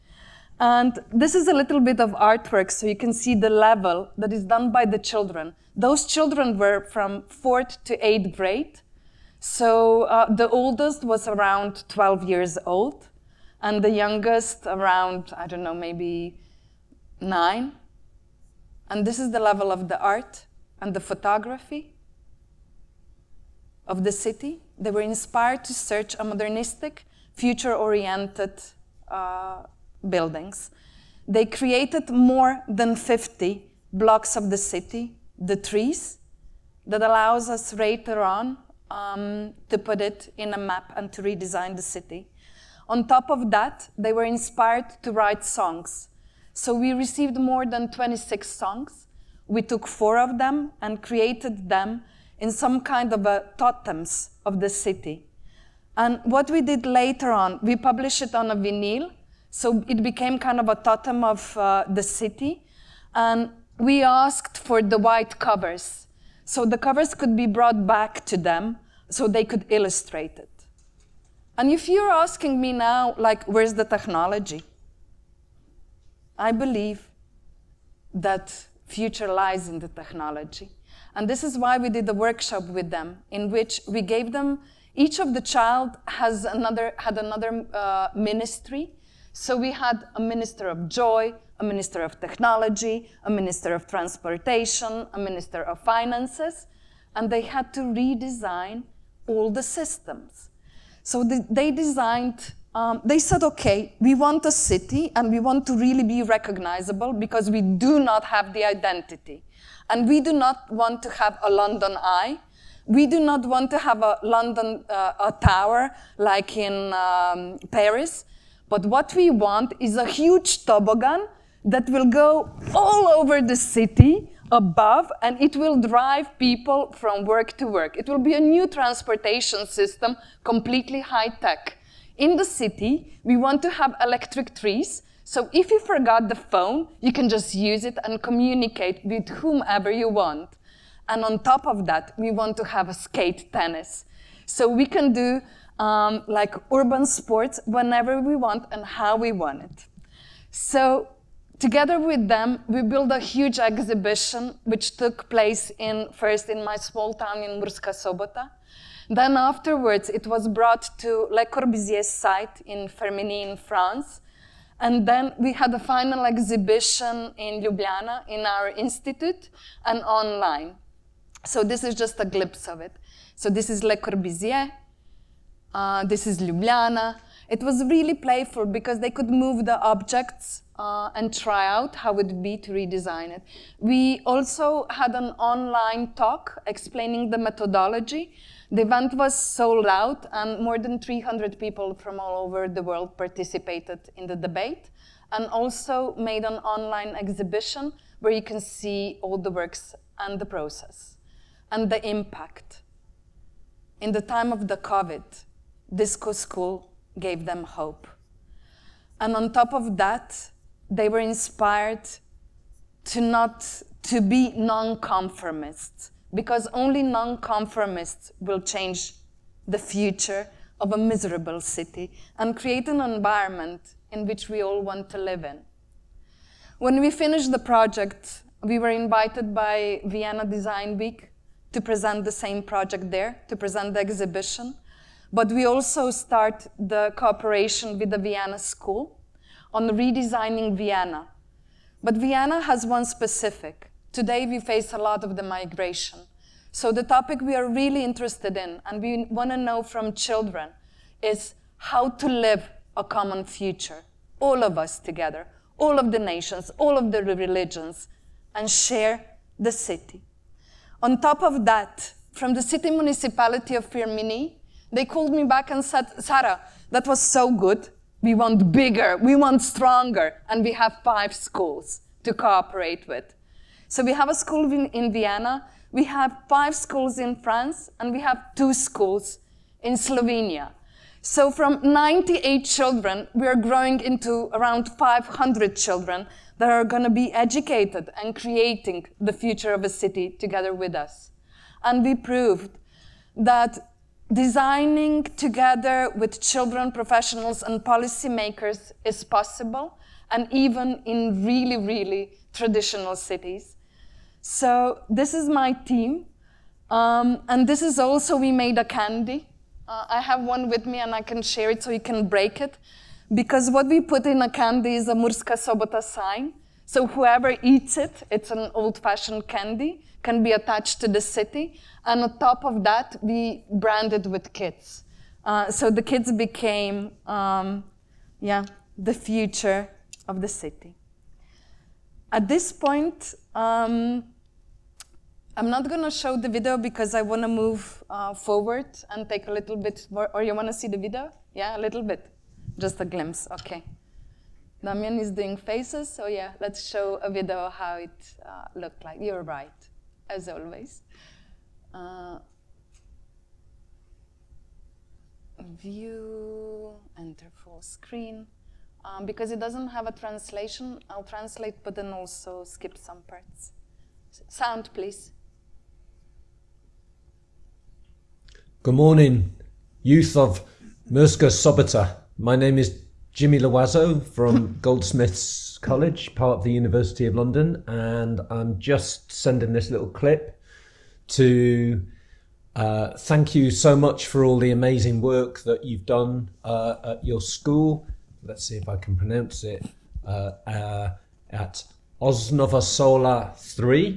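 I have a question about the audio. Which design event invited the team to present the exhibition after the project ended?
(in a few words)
Vienna Design Week.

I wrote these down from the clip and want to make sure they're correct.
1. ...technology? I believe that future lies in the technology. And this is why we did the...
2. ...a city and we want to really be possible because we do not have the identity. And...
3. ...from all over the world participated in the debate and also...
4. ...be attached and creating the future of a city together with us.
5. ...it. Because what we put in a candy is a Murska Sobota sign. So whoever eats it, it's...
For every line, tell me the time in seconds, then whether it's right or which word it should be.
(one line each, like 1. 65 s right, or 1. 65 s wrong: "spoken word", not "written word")
1. 73 s right
2. 104 s wrong: "recognizable", not "possible"
3. 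191 s right
4. 287 s wrong: "educated", not "attached"
5. 312 s right.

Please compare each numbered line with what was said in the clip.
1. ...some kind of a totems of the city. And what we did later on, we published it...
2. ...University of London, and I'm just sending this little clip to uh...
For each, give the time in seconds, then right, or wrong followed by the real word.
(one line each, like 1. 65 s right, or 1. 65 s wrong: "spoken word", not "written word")
1. 52 s right
2. 376 s right.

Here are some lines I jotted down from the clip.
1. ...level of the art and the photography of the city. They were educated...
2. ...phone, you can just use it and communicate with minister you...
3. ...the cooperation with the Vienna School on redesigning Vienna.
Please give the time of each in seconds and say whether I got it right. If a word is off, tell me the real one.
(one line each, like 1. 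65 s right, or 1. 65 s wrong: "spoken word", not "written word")
1. 19 s wrong: "inspired", not "educated"
2. 136 s wrong: "whomever", not "minister"
3. 236 s right.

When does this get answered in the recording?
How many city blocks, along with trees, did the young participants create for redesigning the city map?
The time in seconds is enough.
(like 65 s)
32 s.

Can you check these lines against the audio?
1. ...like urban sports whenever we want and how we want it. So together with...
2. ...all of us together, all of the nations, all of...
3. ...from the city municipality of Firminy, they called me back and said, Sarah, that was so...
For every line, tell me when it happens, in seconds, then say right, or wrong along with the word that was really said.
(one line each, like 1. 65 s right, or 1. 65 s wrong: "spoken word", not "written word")
1. 146 s right
2. 254 s right
3. 262 s right.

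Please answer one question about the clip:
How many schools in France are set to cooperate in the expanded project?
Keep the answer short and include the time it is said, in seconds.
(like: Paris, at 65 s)
5, at 276 s.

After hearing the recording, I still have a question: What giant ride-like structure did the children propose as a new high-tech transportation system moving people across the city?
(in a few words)
toboggan.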